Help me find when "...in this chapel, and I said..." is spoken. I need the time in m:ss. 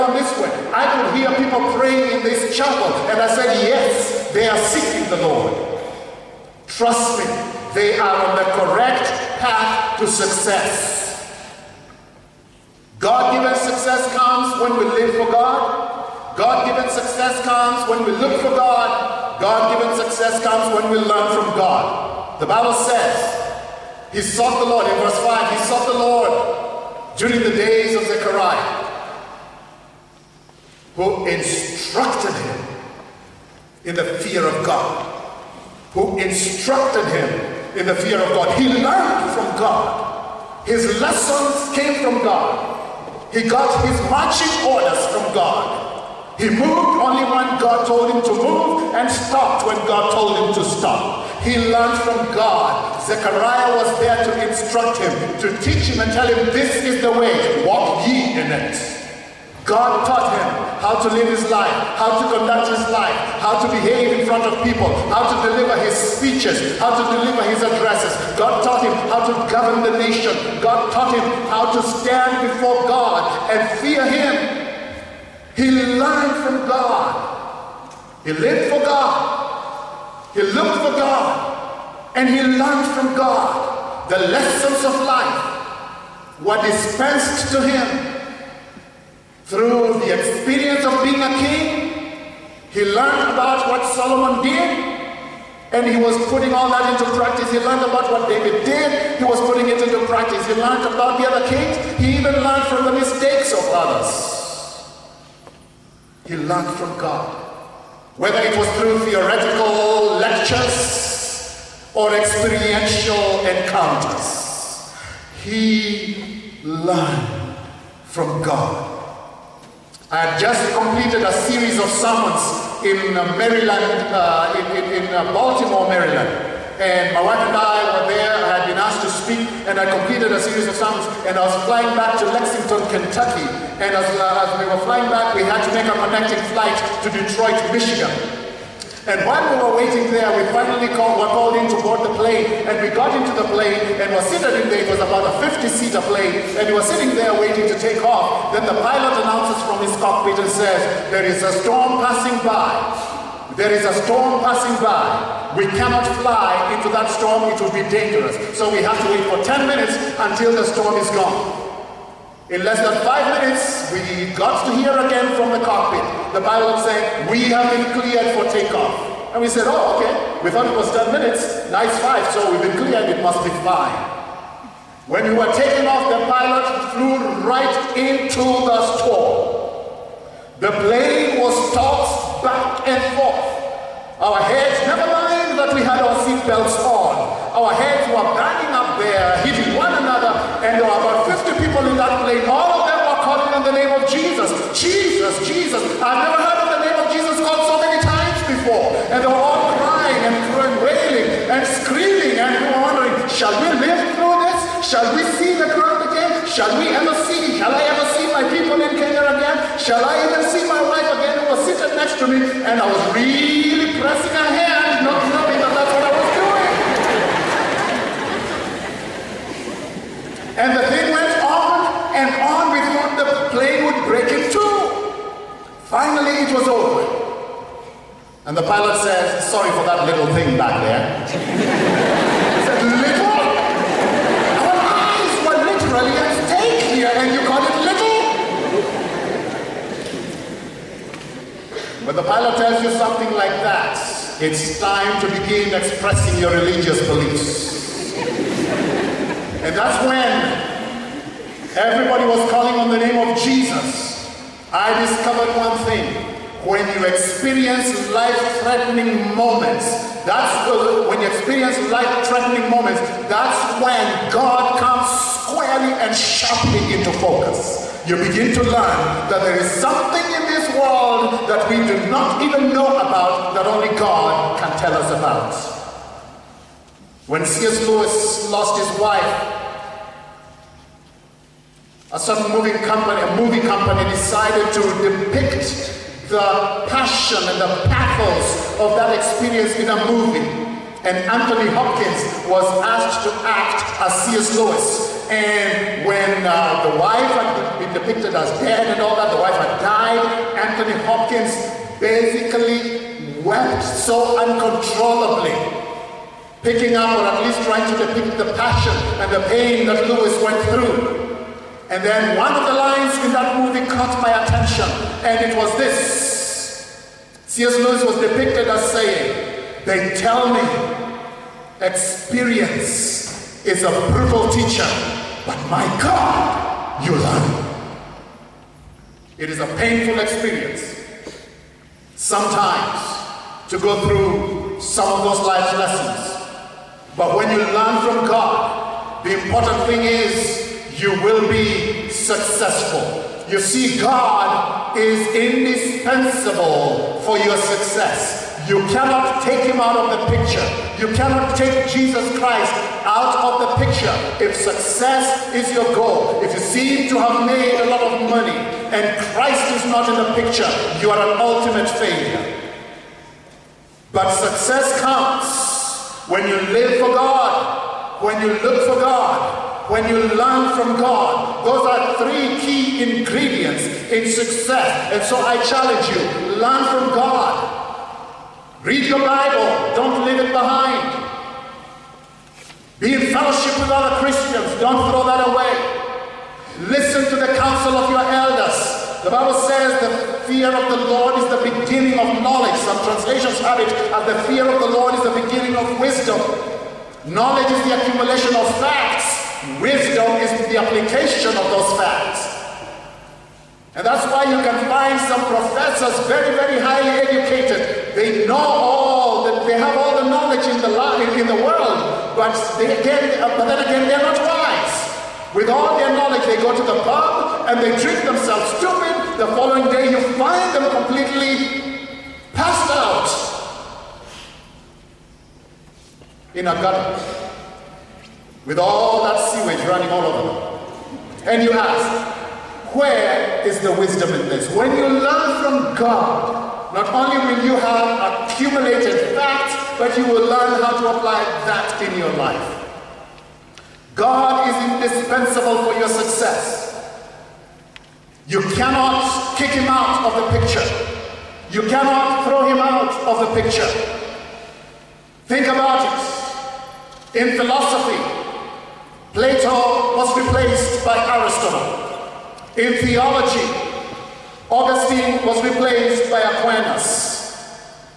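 0:02.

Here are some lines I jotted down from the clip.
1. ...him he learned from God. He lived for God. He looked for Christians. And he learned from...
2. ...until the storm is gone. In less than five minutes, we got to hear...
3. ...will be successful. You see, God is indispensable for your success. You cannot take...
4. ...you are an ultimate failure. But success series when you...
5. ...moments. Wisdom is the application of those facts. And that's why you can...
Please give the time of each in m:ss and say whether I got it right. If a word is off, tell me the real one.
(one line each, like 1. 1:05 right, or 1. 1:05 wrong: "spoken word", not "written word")
1. 1:14 wrong: "God", not "Christians"
2. 2:40 right
3. 5:41 right
4. 6:01 wrong: "comes", not "series"
5. 6:38 wrong: "facts", not "moments".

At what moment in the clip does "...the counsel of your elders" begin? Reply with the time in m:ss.
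6:27.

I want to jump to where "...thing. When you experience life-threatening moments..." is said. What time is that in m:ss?
4:15.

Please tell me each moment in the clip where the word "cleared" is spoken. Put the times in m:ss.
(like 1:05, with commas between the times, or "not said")
2:47, 2:52.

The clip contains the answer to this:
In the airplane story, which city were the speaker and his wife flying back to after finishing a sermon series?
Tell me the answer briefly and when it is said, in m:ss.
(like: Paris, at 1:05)
Lexington, Kentucky, at 2:12.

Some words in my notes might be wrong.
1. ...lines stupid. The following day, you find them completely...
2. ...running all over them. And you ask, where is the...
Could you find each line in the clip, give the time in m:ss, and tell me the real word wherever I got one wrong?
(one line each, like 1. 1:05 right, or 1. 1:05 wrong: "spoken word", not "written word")
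1. 6:58 wrong: "themselves", not "lines"
2. 7:09 right.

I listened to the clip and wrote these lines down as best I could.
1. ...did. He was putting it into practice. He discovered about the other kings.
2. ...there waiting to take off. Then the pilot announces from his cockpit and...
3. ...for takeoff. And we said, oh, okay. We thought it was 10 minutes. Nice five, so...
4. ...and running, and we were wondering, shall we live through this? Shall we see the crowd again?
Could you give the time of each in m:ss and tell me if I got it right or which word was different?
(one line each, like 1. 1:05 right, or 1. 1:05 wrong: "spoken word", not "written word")
1. 1:38 wrong: "learned", not "discovered"
2. 2:27 right
3. 2:48 right
4. 3:21 wrong: "screaming", not "running".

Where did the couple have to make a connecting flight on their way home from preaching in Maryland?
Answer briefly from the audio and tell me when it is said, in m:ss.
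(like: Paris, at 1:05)
Detroit, Michigan, at 2:17.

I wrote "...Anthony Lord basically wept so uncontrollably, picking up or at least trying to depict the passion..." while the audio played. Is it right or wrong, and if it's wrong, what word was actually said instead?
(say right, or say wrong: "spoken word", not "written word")
wrong: "Hopkins", not "Lord".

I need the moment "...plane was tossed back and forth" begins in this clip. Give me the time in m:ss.
3:00.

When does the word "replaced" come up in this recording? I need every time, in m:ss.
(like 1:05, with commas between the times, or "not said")
7:40, 7:45.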